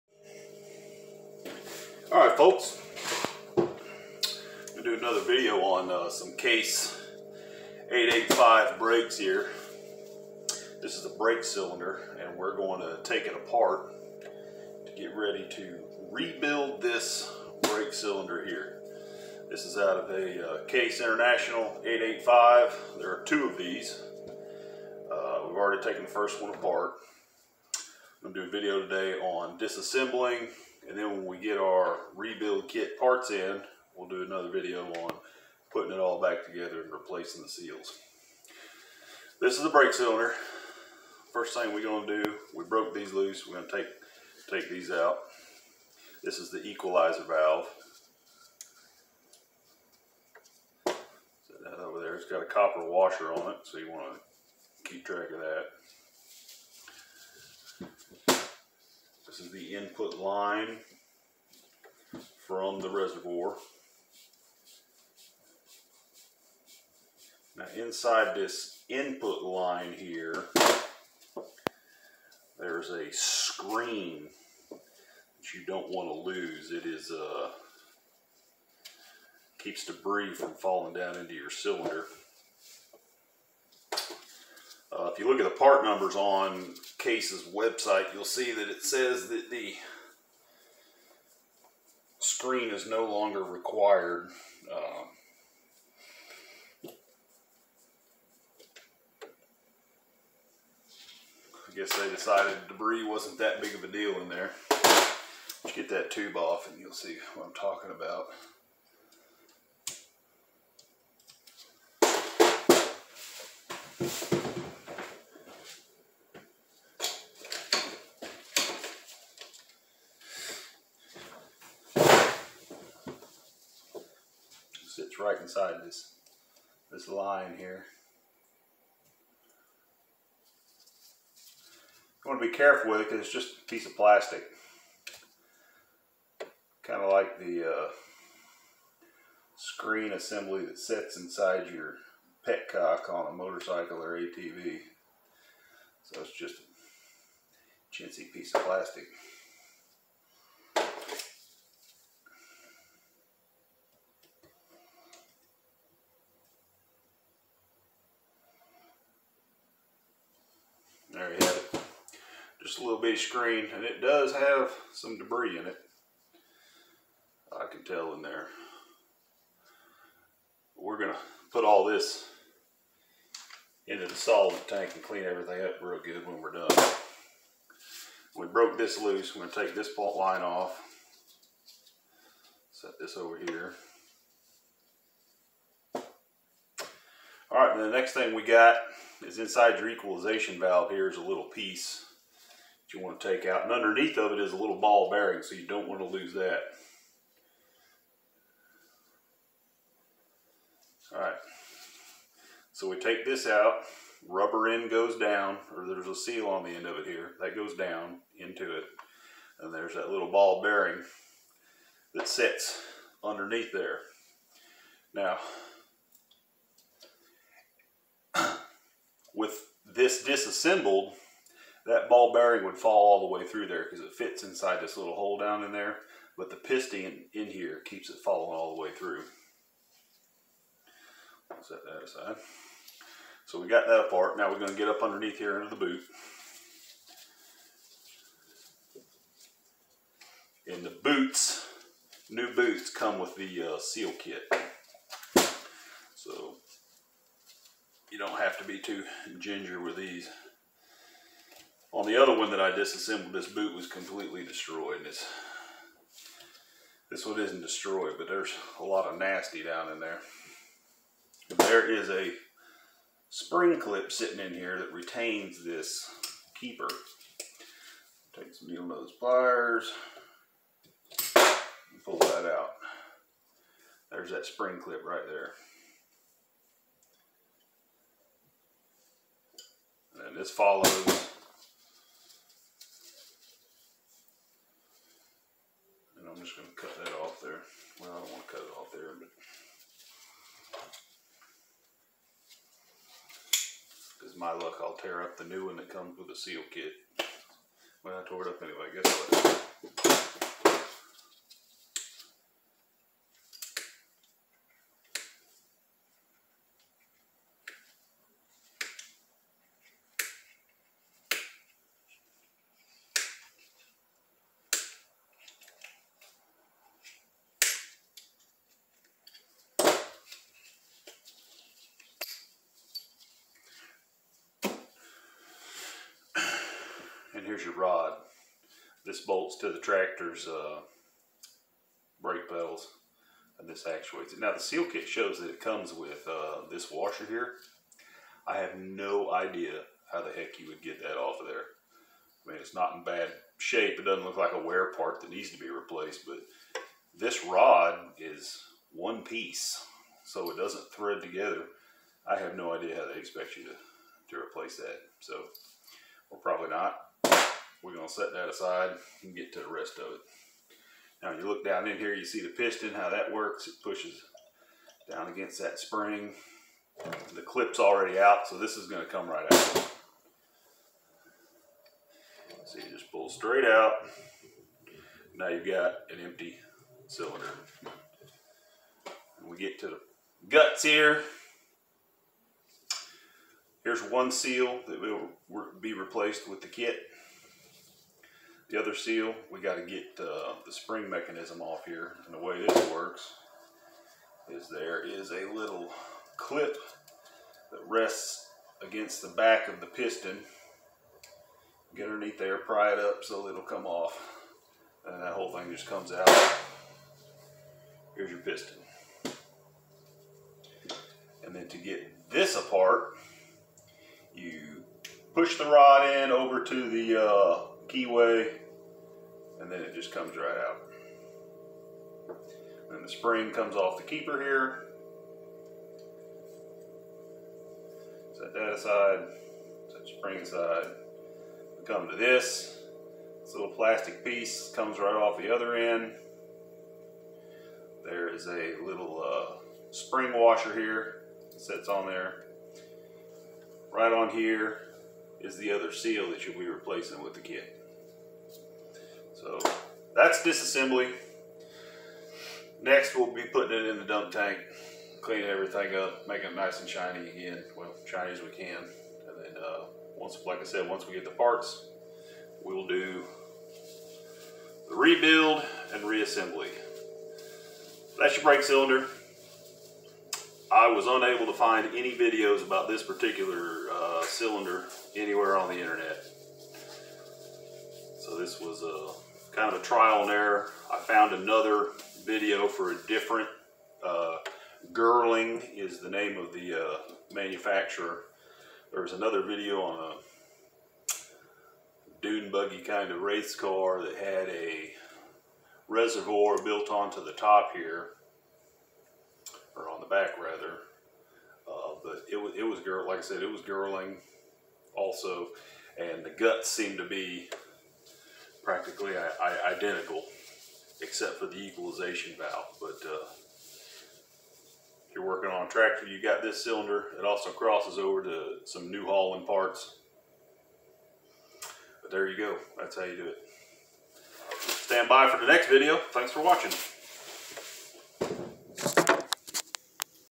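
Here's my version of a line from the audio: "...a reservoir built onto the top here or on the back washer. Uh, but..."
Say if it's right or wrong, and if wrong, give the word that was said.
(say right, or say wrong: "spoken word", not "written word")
wrong: "rather", not "washer".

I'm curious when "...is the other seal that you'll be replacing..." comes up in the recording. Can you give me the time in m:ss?
7:25.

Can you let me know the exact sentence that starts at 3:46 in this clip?
But the piston in here keeps it falling all the way through.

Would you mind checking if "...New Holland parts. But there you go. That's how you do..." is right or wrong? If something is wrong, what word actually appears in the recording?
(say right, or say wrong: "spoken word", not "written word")
right.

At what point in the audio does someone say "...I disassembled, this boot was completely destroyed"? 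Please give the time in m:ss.
4:12.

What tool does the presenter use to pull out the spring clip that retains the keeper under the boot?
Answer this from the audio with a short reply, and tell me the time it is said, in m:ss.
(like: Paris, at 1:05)
needle nose pliers, at 4:28.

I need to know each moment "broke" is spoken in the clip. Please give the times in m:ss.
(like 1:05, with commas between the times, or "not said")
0:42, 2:58.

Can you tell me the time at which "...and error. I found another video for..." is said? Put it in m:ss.
8:00.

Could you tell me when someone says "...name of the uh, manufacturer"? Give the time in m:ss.
8:06.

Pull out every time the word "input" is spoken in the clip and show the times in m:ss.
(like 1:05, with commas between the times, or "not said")
0:59, 1:08.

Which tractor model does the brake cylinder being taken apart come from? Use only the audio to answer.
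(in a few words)
Case International 885.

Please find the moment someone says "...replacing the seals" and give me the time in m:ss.
0:36.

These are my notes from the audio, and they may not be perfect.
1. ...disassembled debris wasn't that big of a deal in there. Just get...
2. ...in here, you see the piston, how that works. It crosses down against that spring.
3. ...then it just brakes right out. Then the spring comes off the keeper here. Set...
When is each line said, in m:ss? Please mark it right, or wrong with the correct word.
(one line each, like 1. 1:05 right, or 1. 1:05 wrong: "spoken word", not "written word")
1. 1:42 wrong: "decided", not "disassembled"
2. 6:01 wrong: "pushes", not "crosses"
3. 6:59 wrong: "comes", not "brakes".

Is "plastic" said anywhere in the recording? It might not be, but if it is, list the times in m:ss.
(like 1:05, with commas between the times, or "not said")
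2:13, 2:28, 7:13.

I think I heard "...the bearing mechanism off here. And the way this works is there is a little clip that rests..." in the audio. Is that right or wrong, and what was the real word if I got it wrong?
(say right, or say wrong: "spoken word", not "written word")
wrong: "spring", not "bearing".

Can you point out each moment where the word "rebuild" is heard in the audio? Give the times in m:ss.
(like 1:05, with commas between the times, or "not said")
0:16, 0:32, 7:44.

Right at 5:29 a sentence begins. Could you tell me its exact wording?
This bolts to the tractor's uh, brake pedals and this actuates it.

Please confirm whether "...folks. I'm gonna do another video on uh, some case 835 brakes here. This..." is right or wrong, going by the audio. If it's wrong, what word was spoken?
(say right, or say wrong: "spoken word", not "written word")
wrong: "885", not "835".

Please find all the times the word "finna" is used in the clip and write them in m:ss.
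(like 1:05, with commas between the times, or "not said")
not said.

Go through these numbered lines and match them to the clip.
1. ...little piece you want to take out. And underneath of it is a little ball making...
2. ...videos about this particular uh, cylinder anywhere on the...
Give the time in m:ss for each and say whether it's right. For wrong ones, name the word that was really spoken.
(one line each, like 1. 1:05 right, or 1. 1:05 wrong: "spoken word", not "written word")
1. 3:11 wrong: "bearing", not "making"
2. 7:52 right.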